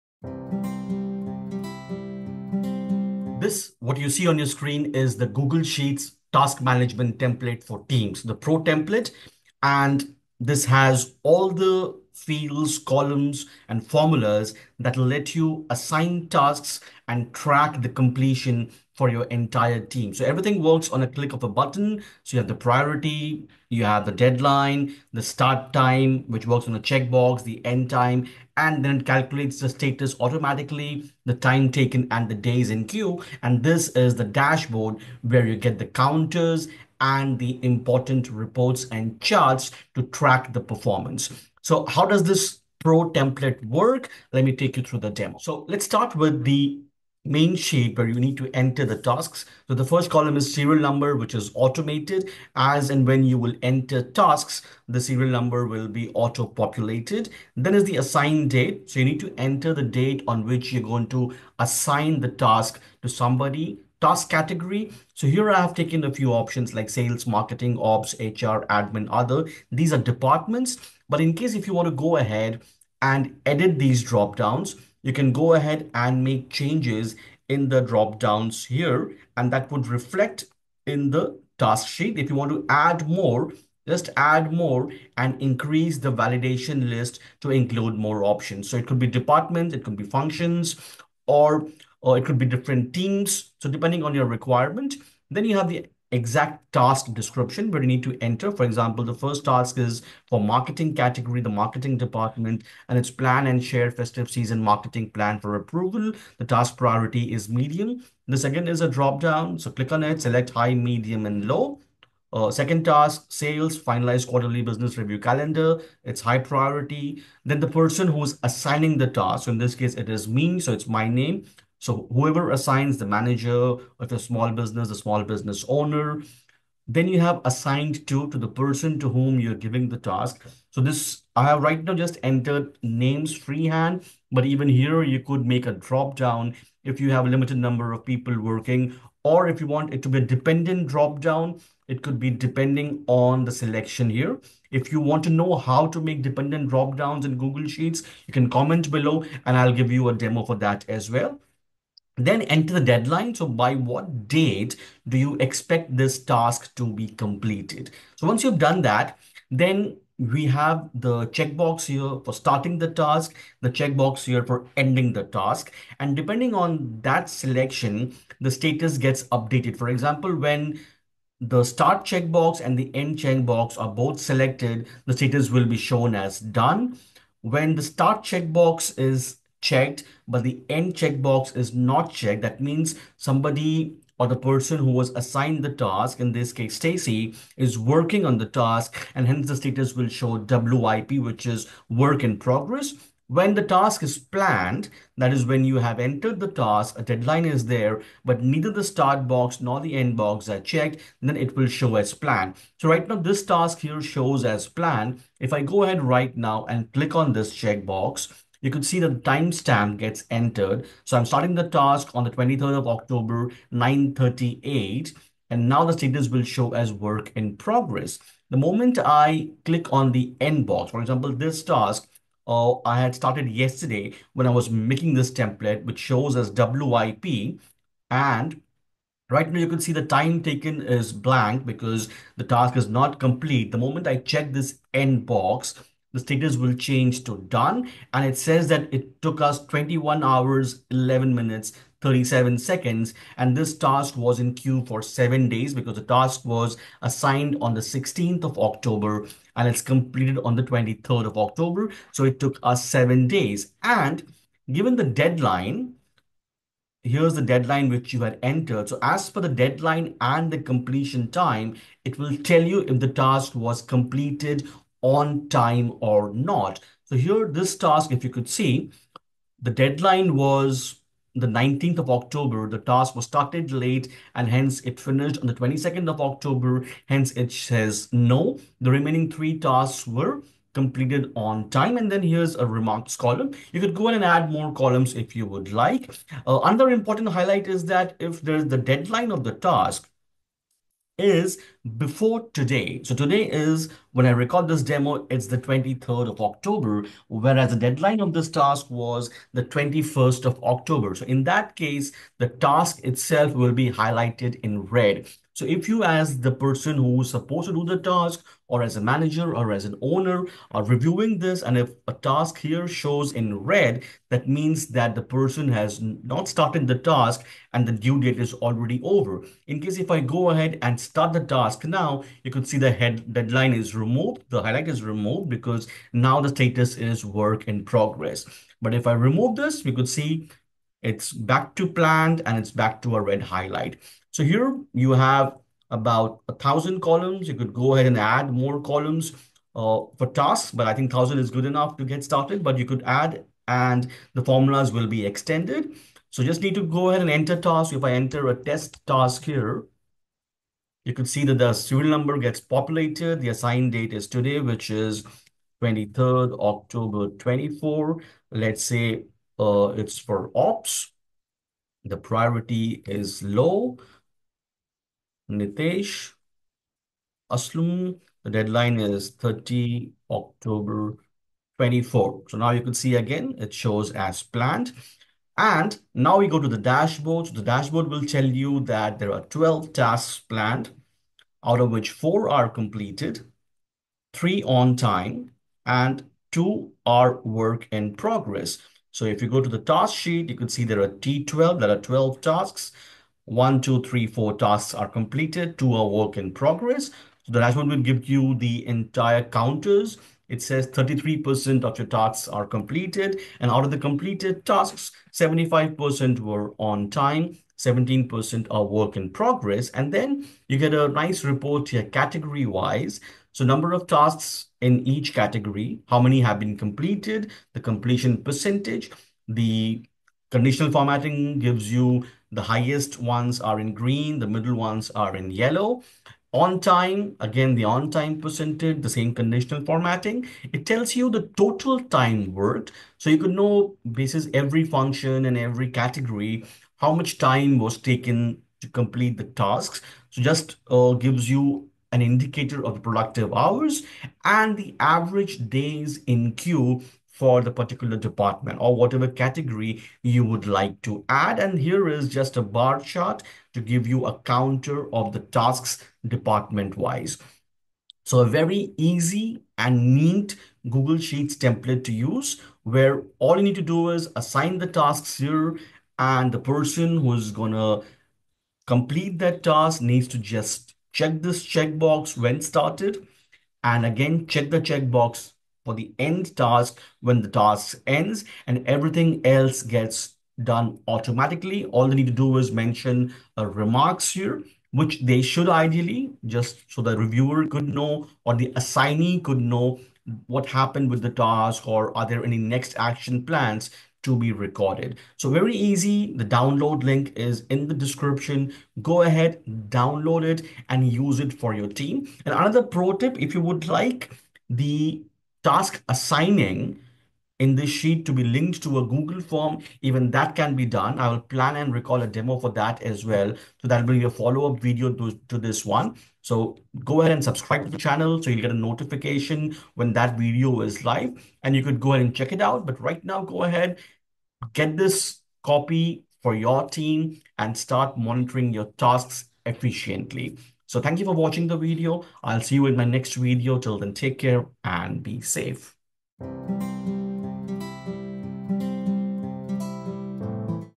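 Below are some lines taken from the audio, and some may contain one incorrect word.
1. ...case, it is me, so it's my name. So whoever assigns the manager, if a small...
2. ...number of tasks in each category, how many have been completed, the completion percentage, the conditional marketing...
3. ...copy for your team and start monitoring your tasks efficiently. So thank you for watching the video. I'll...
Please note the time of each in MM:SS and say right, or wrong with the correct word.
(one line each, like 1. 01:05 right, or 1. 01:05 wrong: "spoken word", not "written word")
1. 01:59 right
2. 06:53 wrong: "formatting", not "marketing"
3. 08:45 right.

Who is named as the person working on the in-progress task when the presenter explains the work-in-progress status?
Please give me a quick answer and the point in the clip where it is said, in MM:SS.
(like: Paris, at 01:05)
Stacy, at 03:06.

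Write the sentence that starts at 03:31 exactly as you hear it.
So I'm starting the task on the 23rd of October, 9.38, and now the status will show as work in progress.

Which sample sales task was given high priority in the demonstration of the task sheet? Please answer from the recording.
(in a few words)
Finalize quarterly business review calendar.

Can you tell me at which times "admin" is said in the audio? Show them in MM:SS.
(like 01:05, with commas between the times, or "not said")
01:08.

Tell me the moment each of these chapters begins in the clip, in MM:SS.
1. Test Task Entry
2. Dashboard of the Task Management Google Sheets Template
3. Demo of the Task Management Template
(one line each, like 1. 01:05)
1. 05:46
2. 06:17
3. 00:44.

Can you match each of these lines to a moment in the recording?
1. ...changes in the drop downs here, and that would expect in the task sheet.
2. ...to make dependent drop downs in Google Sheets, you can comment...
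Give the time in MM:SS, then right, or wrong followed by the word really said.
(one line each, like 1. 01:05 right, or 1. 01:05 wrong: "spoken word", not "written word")
1. 01:16 wrong: "reflect", not "expect"
2. 02:25 right.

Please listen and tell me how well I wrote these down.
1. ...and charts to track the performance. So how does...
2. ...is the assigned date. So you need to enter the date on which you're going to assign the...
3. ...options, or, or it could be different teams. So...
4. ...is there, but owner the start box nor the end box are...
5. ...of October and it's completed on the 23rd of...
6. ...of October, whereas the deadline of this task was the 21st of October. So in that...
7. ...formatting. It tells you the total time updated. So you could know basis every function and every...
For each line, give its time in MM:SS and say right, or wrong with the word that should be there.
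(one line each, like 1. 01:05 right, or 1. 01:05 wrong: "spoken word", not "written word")
1. 00:38 right
2. 00:57 right
3. 01:30 wrong: "functions", not "options"
4. 03:17 wrong: "neither", not "owner"
5. 04:08 right
6. 04:56 right
7. 07:09 wrong: "worked", not "updated".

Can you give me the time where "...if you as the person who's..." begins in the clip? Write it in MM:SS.
05:05.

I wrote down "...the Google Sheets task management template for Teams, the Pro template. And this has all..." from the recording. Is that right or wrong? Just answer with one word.
right.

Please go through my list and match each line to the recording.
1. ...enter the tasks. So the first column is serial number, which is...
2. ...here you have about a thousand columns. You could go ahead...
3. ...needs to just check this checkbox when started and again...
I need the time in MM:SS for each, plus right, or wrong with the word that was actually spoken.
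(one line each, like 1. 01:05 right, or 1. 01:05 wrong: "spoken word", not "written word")
1. 00:48 right
2. 05:34 right
3. 07:50 right.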